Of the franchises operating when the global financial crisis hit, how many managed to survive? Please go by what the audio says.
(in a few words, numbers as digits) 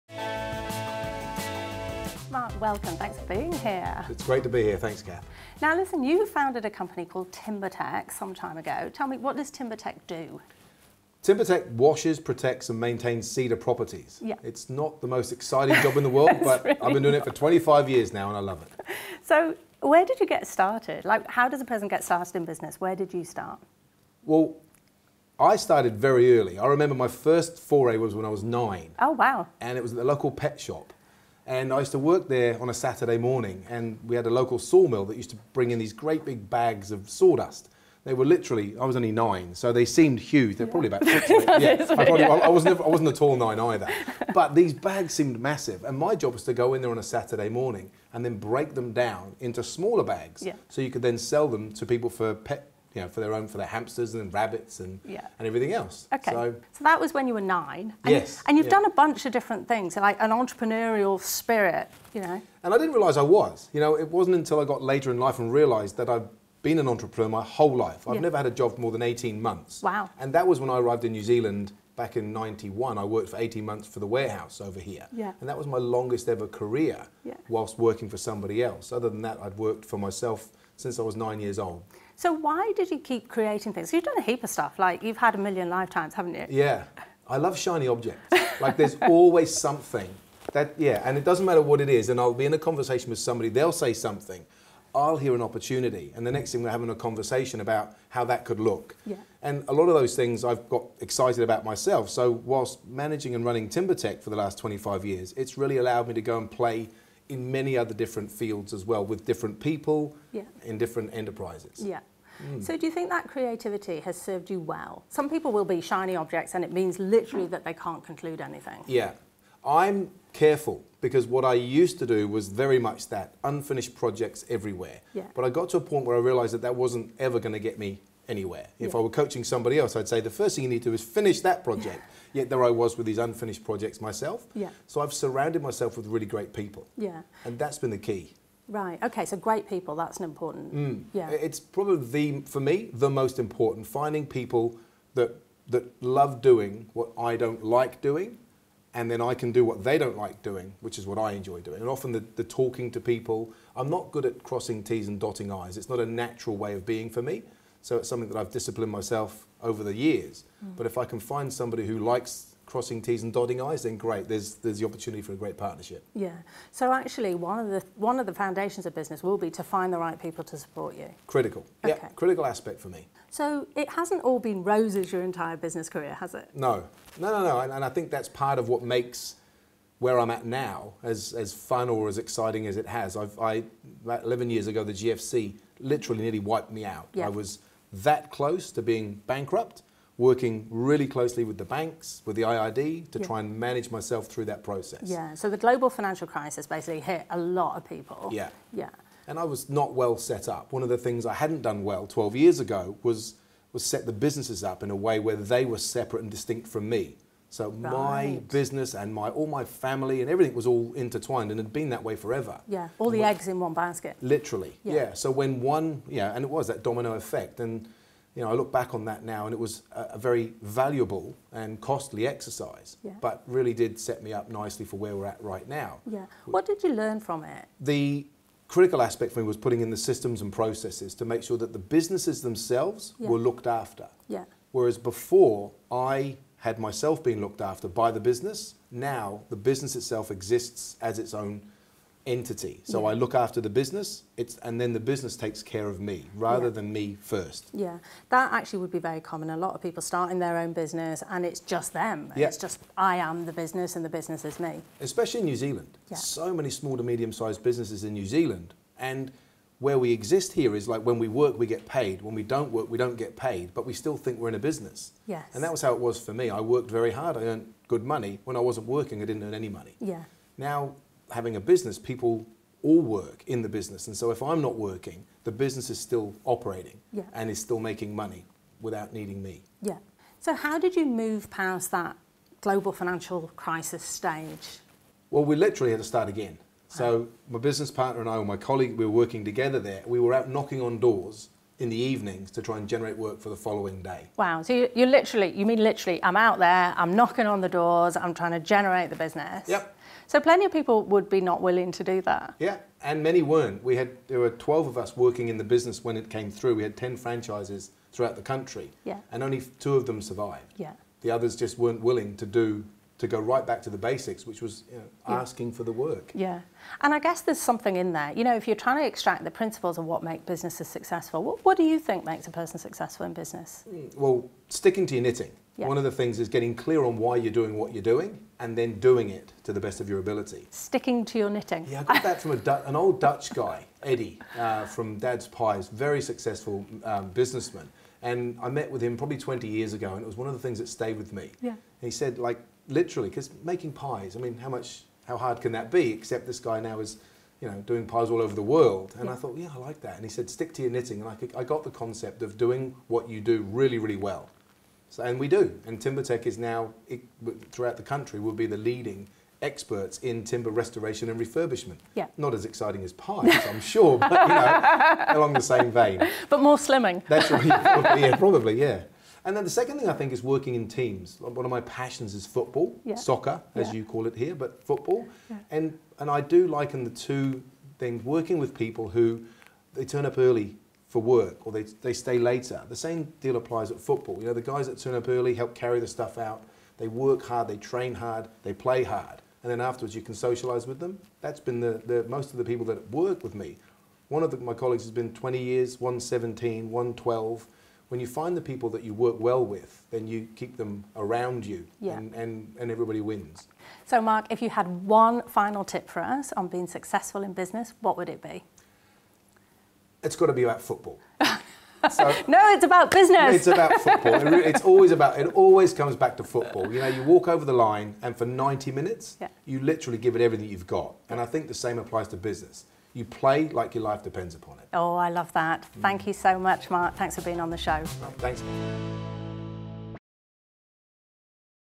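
2.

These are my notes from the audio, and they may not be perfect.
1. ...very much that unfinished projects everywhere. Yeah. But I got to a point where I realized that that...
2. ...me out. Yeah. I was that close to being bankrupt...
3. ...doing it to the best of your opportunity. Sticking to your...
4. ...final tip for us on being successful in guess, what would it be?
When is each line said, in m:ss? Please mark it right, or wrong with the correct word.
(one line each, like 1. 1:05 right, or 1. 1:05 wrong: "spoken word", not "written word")
1. 2:02 right
2. 3:06 right
3. 5:28 wrong: "ability", not "opportunity"
4. 6:45 wrong: "business", not "guess".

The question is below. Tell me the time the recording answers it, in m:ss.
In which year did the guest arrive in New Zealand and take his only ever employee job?
1:12.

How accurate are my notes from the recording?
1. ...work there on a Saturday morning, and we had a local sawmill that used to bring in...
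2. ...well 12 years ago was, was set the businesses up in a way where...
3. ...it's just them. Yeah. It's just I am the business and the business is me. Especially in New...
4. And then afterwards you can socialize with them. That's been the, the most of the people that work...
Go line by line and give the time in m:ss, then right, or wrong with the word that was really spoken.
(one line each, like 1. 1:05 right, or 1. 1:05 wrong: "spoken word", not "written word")
1. 0:31 right
2. 3:21 right
3. 4:11 right
4. 6:29 right.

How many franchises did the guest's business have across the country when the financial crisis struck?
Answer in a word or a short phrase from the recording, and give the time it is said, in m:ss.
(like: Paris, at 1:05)
10, at 5:06.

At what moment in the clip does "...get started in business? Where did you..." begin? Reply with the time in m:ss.
0:21.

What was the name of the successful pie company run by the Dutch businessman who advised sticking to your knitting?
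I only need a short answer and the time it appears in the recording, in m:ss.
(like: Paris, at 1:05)
Dad's Pies, at 5:35.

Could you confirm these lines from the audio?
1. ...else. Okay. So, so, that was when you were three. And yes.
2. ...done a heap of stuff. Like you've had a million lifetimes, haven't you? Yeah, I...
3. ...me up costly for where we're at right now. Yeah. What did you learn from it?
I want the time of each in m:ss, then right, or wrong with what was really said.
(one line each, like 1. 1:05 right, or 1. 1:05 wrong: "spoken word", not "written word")
1. 0:55 wrong: "nine", not "three"
2. 1:24 right
3. 3:44 wrong: "nicely", not "costly".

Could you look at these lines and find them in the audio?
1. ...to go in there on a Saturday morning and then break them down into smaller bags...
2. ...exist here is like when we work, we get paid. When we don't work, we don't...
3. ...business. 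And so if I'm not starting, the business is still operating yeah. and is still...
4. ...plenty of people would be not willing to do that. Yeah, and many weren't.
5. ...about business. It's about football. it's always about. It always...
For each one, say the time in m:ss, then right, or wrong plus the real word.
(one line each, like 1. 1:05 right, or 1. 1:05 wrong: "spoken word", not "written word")
1. 0:46 right
2. 4:20 right
3. 4:33 wrong: "working", not "starting"
4. 5:00 right
5. 6:52 right.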